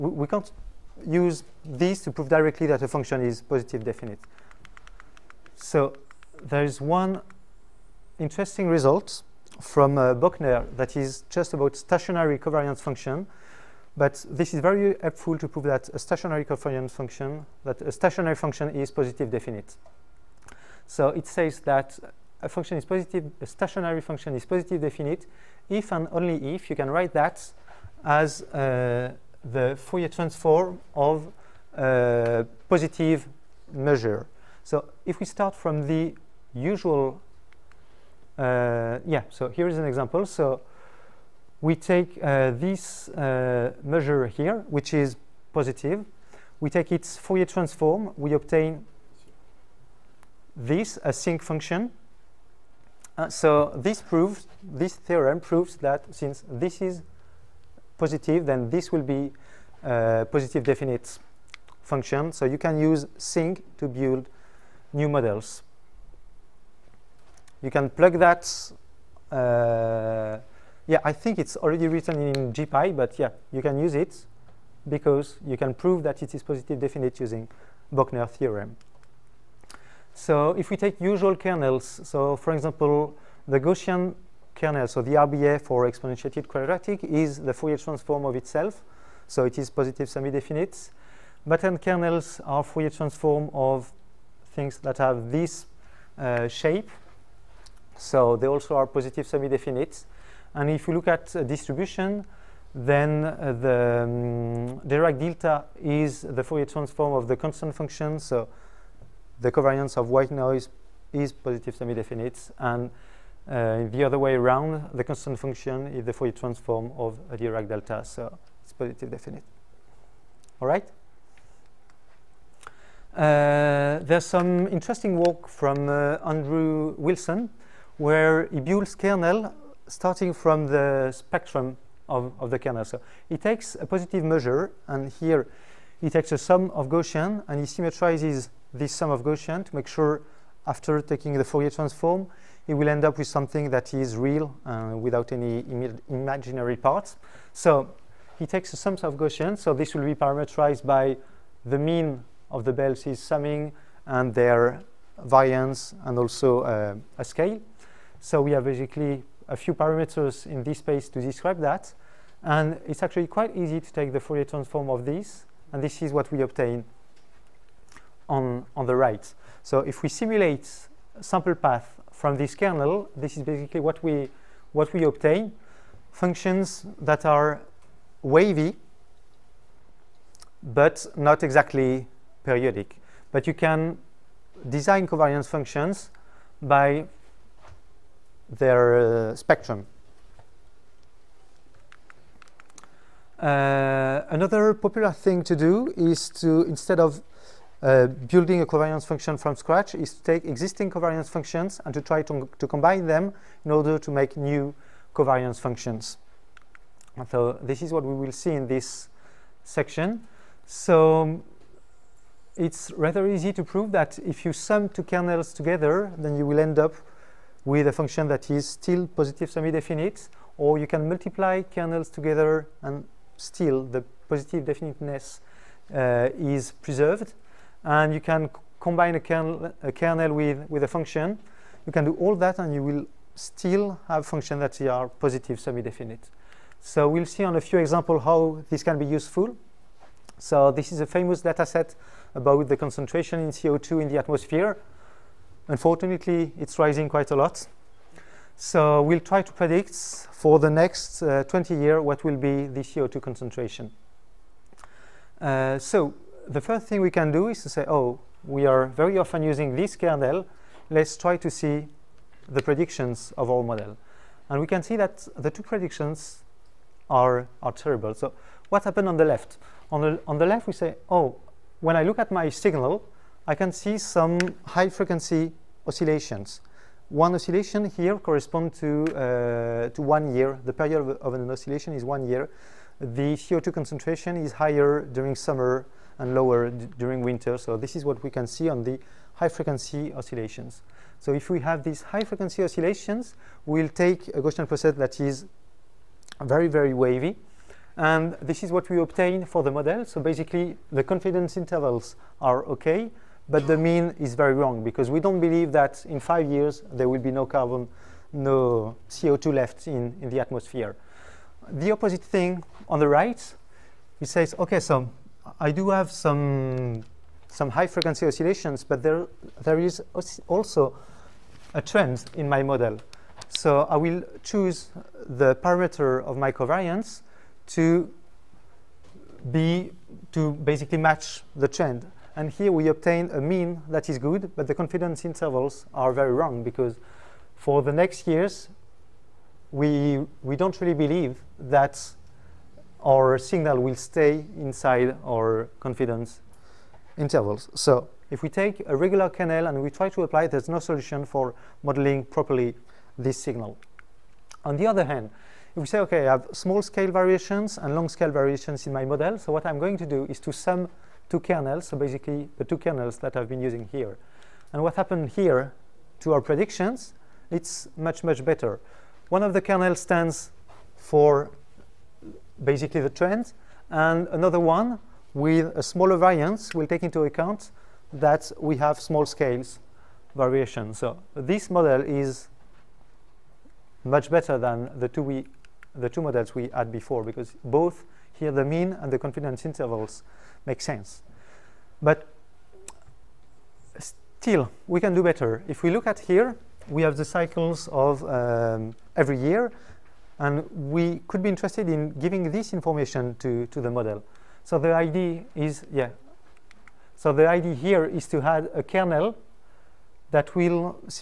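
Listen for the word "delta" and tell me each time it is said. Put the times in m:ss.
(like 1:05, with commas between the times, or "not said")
1:45, 1:57.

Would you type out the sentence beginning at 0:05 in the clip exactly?
So there is one interesting result from uh, Bochner that is just about stationary covariance function.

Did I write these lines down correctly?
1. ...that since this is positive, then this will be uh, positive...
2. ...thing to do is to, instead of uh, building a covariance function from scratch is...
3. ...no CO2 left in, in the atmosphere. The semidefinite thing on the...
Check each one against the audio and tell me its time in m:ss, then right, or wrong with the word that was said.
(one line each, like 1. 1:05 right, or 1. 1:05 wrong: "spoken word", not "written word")
1. 0:55 right
2. 3:15 right
3. 5:08 wrong: "opposite", not "semidefinite".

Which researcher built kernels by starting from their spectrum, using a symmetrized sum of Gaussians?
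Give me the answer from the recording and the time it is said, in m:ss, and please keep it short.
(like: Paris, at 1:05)
Andrew Wilson, at 2:06.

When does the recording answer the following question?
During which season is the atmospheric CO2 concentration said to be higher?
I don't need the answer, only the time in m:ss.
4:45.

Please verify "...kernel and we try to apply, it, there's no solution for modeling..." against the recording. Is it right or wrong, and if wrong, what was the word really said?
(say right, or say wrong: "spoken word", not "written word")
right.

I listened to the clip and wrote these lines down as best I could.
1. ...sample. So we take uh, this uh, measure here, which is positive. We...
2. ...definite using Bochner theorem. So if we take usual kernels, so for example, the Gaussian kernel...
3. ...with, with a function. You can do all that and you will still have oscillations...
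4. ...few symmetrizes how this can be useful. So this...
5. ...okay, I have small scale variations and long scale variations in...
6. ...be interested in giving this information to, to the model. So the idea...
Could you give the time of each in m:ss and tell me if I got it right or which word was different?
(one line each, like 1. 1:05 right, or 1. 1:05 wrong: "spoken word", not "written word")
1. 0:39 wrong: "example", not "sample"
2. 1:16 right
3. 3:50 wrong: "functions", not "oscillations"
4. 3:57 wrong: "examples", not "symmetrizes"
5. 5:56 right
6. 6:41 right.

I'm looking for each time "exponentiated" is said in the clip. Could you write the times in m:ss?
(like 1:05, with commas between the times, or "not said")
1:25.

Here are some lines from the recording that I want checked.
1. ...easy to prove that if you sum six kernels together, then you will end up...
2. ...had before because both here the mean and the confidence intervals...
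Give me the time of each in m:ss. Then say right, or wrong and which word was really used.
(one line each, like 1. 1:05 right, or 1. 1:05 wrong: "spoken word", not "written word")
1. 3:33 wrong: "two", not "six"
2. 6:26 right.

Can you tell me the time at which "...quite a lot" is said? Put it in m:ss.
4:07.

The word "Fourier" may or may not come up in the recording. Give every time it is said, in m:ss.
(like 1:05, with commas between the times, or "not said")
0:29, 0:47, 1:27, 1:32, 1:46, 1:56, 2:21, 2:44.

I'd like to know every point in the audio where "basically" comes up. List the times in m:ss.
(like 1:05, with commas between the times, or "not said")
2:38, 2:53, 5:00, 5:30, 6:01, 6:12.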